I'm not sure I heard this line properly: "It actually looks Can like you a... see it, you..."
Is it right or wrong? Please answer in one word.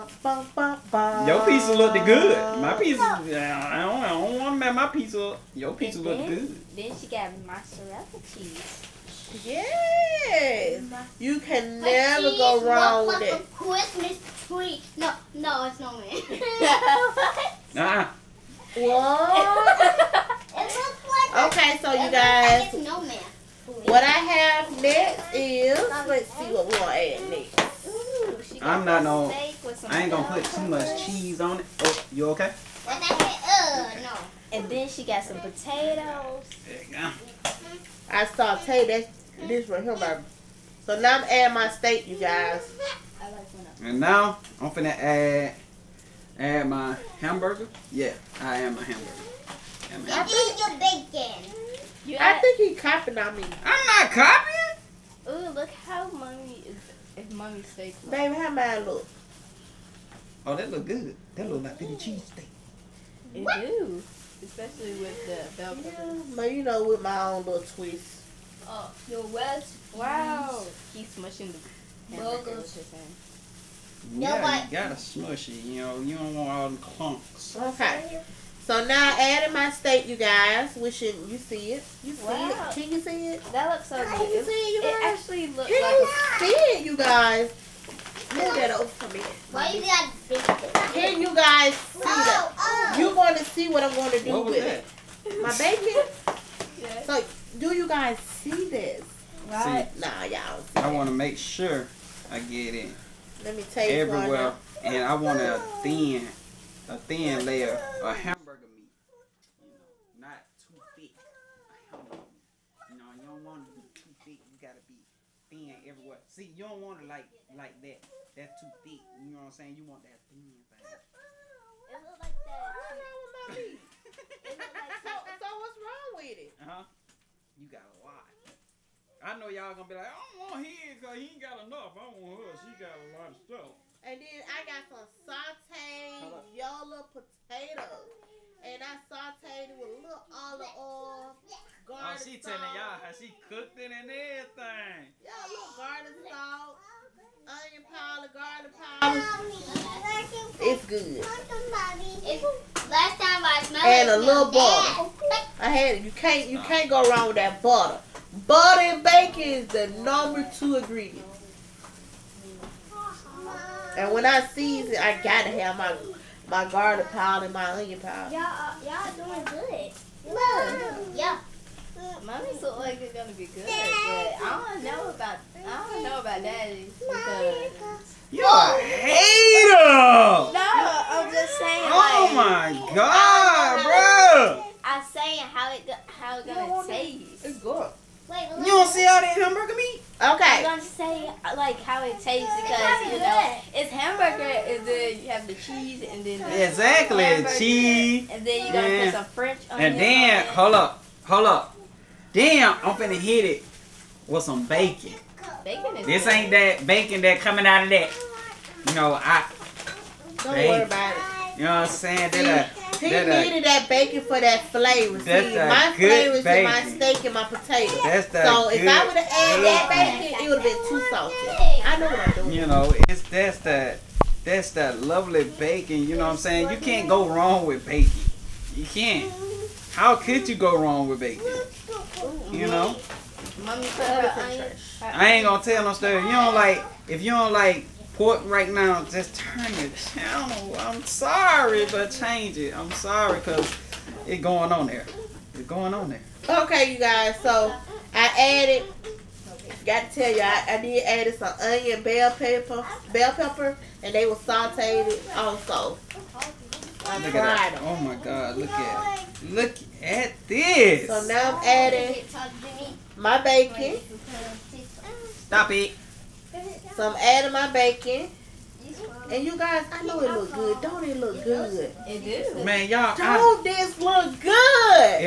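right.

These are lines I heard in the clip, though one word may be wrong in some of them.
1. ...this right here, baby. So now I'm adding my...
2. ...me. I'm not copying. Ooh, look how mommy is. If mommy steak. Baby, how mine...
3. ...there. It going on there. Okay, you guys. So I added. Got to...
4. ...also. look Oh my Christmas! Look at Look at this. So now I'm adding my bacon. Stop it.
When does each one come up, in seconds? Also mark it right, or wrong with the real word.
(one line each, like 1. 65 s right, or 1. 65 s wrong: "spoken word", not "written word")
1. 39 s right
2. 53 s right
3. 244 s right
4. 255 s wrong: "God", not "Christmas".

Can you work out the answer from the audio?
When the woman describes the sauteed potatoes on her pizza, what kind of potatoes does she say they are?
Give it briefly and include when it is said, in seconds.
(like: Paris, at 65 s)
Yola potatoes, at 136 s.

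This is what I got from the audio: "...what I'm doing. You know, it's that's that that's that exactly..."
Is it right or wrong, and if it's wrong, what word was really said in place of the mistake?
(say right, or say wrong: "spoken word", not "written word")
wrong: "lovely", not "exactly".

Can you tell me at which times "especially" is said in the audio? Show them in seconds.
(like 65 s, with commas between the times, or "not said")
64 s.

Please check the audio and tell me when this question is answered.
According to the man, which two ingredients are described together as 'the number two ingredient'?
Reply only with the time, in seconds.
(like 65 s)
158 s.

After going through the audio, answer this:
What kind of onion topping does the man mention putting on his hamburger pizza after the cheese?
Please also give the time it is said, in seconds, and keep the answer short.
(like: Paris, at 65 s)
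French onion, at 199 s.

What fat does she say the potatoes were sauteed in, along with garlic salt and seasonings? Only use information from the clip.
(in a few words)
olive oil.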